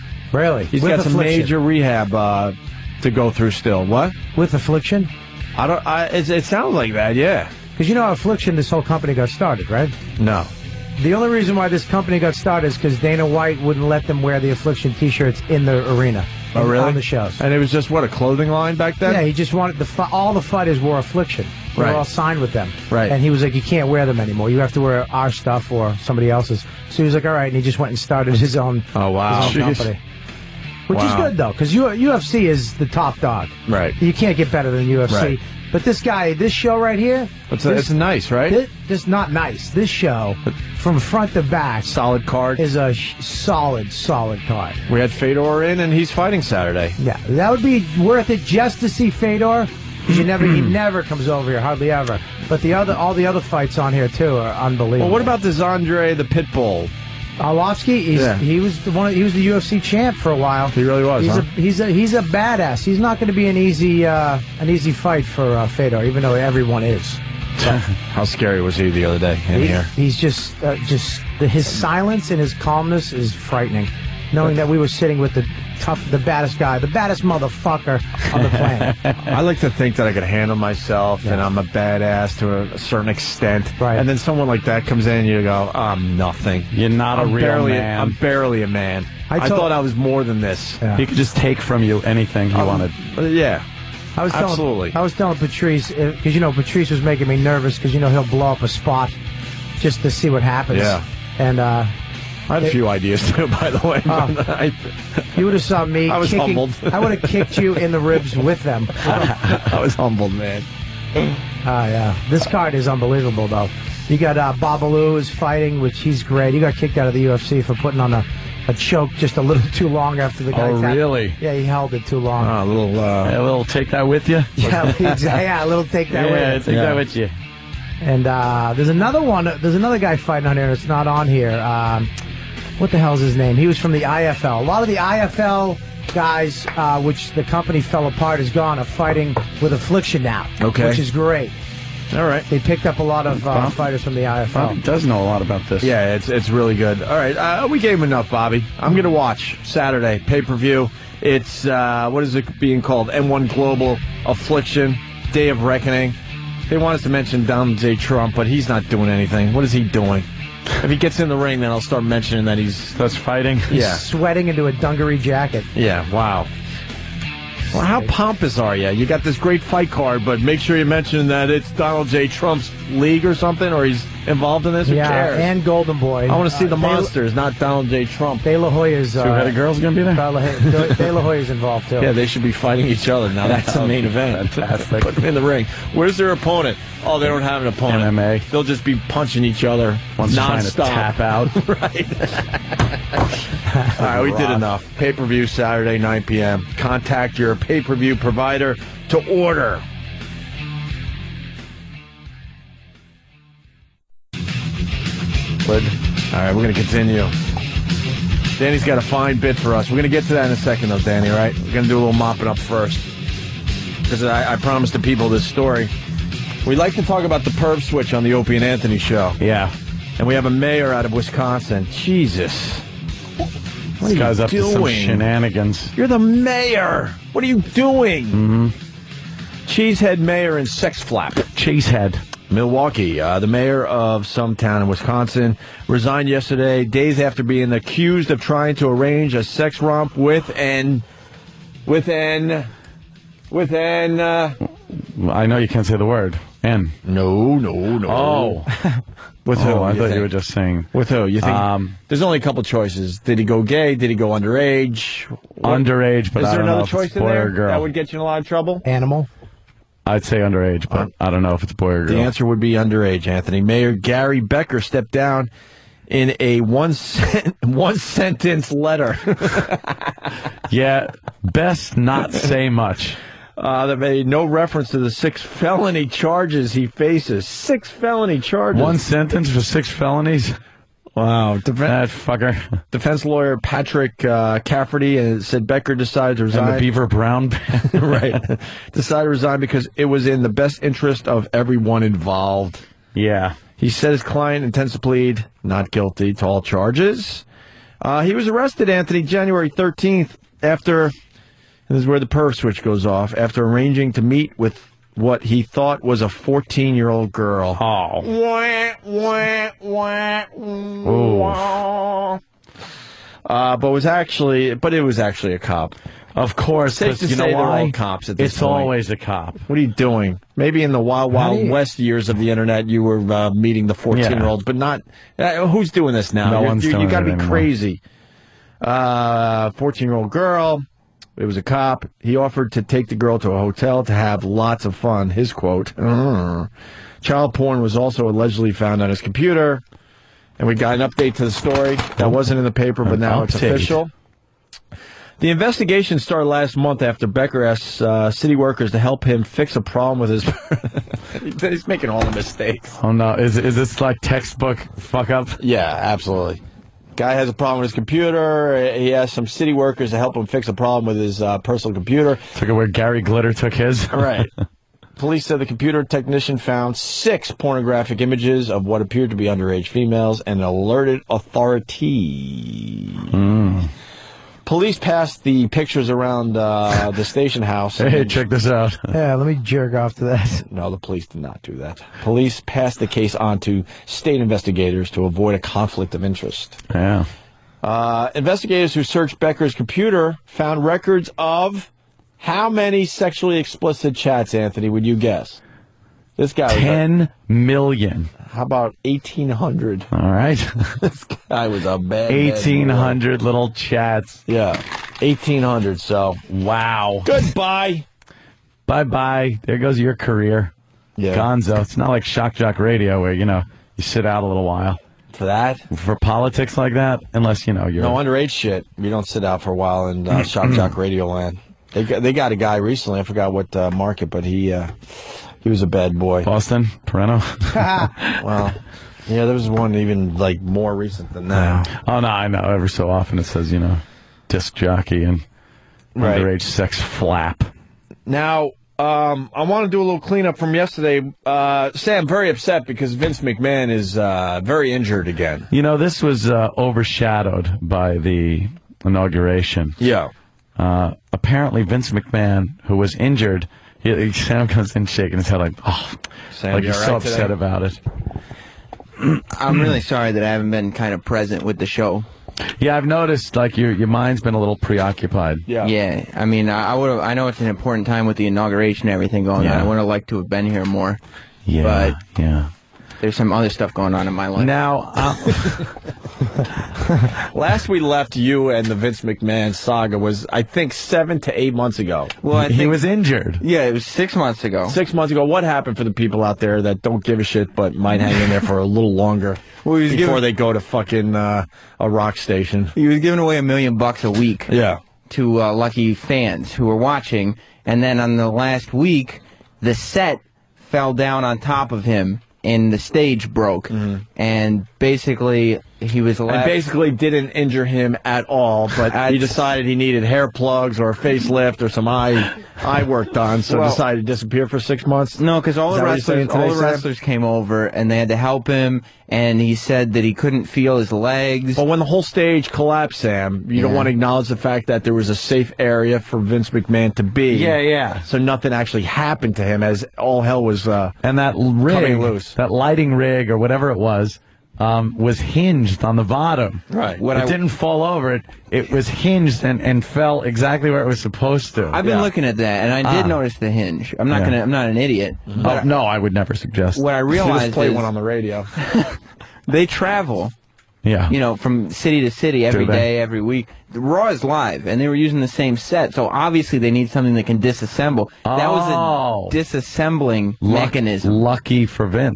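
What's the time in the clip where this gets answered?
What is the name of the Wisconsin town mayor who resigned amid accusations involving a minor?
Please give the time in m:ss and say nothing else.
4:23.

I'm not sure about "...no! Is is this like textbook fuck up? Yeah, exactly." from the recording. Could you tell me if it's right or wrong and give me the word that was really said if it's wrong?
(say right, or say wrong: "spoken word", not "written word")
wrong: "absolutely", not "exactly".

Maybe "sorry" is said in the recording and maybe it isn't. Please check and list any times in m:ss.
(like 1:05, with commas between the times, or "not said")
7:40.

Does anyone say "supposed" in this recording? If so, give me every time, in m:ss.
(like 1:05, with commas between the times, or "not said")
9:01.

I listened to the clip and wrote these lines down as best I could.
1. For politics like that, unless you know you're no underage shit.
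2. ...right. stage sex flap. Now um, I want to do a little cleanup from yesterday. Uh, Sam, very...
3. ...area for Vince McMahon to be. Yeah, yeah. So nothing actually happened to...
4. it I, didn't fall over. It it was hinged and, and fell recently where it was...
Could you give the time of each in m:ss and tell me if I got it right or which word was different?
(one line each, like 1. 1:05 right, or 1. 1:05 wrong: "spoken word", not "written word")
1. 6:55 right
2. 7:16 wrong: "underage", not "stage"
3. 8:45 right
4. 8:57 wrong: "exactly", not "recently".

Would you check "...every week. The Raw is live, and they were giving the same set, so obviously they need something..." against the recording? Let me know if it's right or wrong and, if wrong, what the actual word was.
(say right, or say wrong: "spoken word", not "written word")
wrong: "using", not "giving".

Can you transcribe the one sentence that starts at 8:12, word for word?
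He was giving away a million bucks a week.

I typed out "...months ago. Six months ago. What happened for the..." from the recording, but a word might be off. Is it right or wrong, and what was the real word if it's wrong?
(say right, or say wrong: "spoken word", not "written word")
right.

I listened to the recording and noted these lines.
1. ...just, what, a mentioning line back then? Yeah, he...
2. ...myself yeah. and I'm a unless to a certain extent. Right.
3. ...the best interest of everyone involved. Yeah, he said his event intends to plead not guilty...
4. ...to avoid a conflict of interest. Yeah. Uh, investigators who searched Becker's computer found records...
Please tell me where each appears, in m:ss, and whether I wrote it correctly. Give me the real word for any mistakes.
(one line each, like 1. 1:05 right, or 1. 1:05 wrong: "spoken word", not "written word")
1. 0:17 wrong: "clothing", not "mentioning"
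2. 1:20 wrong: "badass", not "unless"
3. 4:50 wrong: "client", not "event"
4. 6:25 right.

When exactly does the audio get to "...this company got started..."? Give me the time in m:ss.
0:11.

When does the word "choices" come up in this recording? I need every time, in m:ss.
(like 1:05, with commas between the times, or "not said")
4:12, 4:16.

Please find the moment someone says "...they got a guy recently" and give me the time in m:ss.
7:02.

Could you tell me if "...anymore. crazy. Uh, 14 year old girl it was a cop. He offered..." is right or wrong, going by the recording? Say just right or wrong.
right.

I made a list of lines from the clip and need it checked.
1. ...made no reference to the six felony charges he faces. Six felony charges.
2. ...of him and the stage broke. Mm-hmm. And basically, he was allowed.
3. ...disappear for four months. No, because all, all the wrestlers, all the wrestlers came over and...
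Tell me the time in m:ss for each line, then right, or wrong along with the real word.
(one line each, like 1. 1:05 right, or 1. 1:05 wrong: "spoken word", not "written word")
1. 4:33 right
2. 8:21 right
3. 8:34 wrong: "six", not "four".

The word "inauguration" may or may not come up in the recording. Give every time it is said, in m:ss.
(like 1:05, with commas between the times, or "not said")
7:29, 7:48.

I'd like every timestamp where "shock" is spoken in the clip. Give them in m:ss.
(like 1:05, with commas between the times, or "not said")
6:52, 7:00.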